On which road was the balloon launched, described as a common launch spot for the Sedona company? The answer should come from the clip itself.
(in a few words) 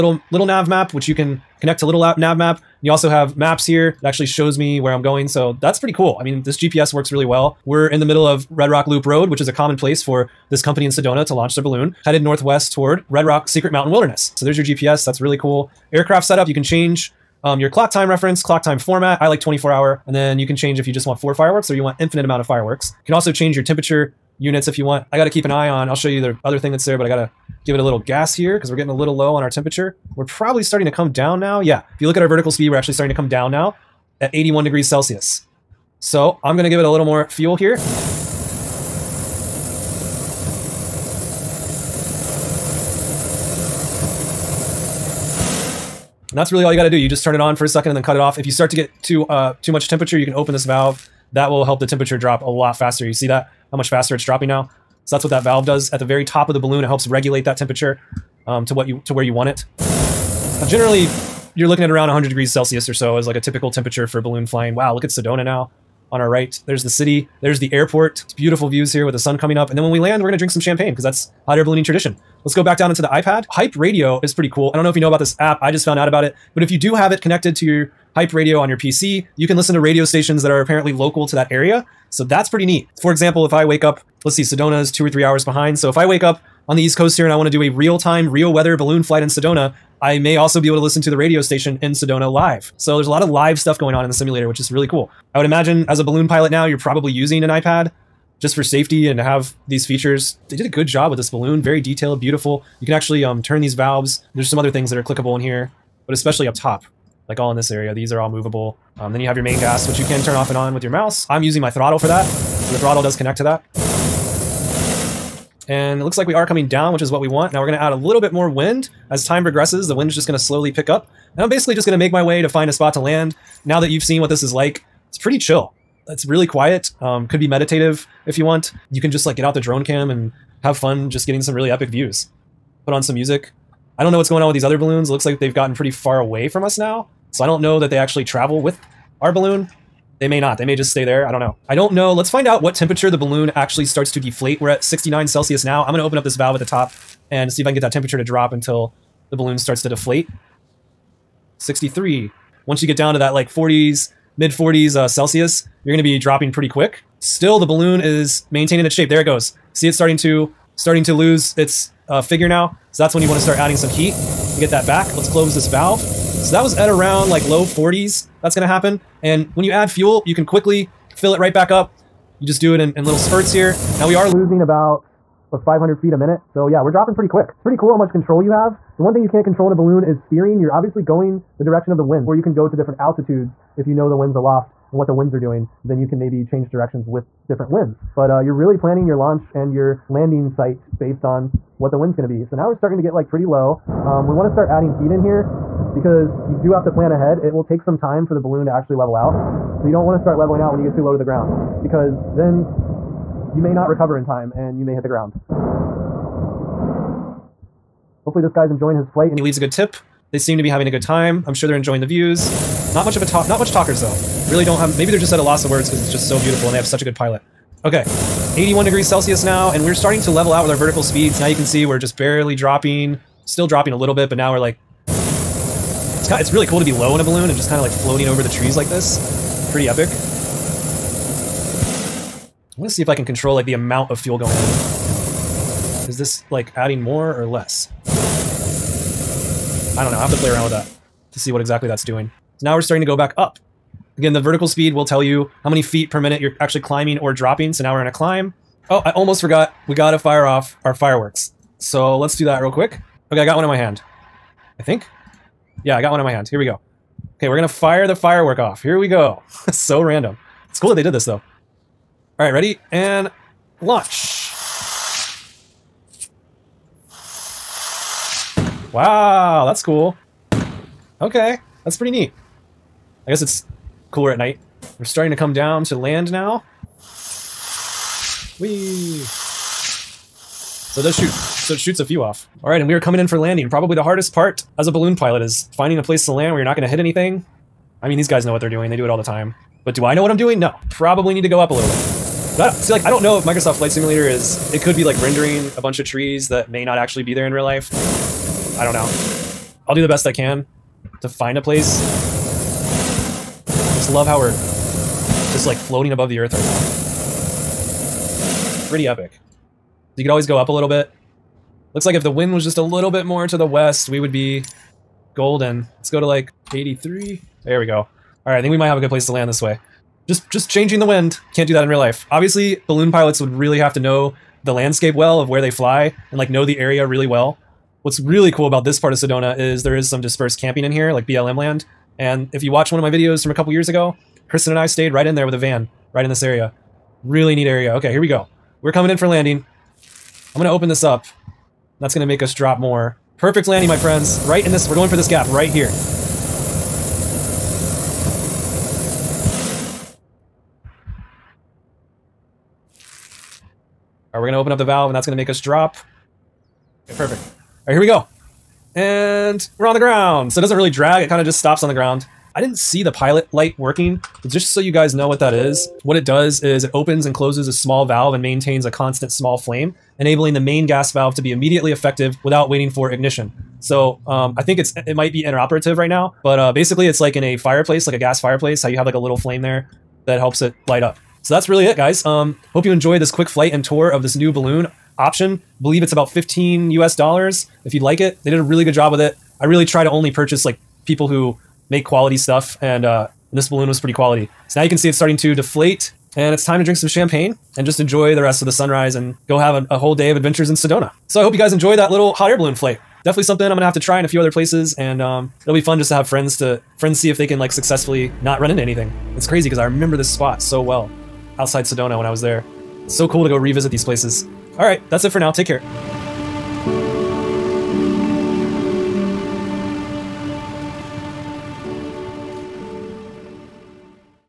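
Red Rock Loop Road.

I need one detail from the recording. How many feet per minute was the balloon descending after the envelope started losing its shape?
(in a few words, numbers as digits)
500.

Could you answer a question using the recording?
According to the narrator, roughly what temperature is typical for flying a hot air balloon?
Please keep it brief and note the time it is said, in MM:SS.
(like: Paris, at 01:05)
100 degrees Celsius, at 01:02.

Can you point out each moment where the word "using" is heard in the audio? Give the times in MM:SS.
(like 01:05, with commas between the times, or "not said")
01:37, 01:51.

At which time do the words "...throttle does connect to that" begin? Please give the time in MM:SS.
01:52.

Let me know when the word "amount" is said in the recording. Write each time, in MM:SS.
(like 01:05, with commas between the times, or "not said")
00:22, 03:53.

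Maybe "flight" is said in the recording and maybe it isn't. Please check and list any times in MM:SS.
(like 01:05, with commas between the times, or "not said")
01:29, 03:29, 04:53, 06:23, 06:42.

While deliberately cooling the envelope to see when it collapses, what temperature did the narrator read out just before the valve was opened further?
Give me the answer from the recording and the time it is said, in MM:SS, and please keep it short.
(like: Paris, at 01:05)
69 Celsius, at 02:24.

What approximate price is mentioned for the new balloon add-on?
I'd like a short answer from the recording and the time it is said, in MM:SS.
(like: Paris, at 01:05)
15 US dollars, at 06:26.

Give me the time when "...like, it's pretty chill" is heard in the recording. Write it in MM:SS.
02:04.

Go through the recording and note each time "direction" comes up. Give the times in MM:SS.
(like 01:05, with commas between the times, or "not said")
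03:01, 03:06.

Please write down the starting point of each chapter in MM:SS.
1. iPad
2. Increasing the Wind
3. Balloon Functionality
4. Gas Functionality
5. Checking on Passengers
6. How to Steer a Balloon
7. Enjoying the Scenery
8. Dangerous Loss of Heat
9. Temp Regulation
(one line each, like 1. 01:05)
1. 01:12
2. 01:56
3. 01:40
4. 03:52
5. 03:27
6. 02:56
7. 02:02
8. 02:22
9. 00:32.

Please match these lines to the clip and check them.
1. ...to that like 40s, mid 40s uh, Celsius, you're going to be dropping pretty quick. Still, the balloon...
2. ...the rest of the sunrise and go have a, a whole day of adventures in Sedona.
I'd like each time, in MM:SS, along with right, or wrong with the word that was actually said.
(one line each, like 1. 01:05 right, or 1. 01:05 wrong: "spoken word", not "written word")
1. 02:33 right
2. 06:38 right.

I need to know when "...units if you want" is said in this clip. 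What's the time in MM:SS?
00:24.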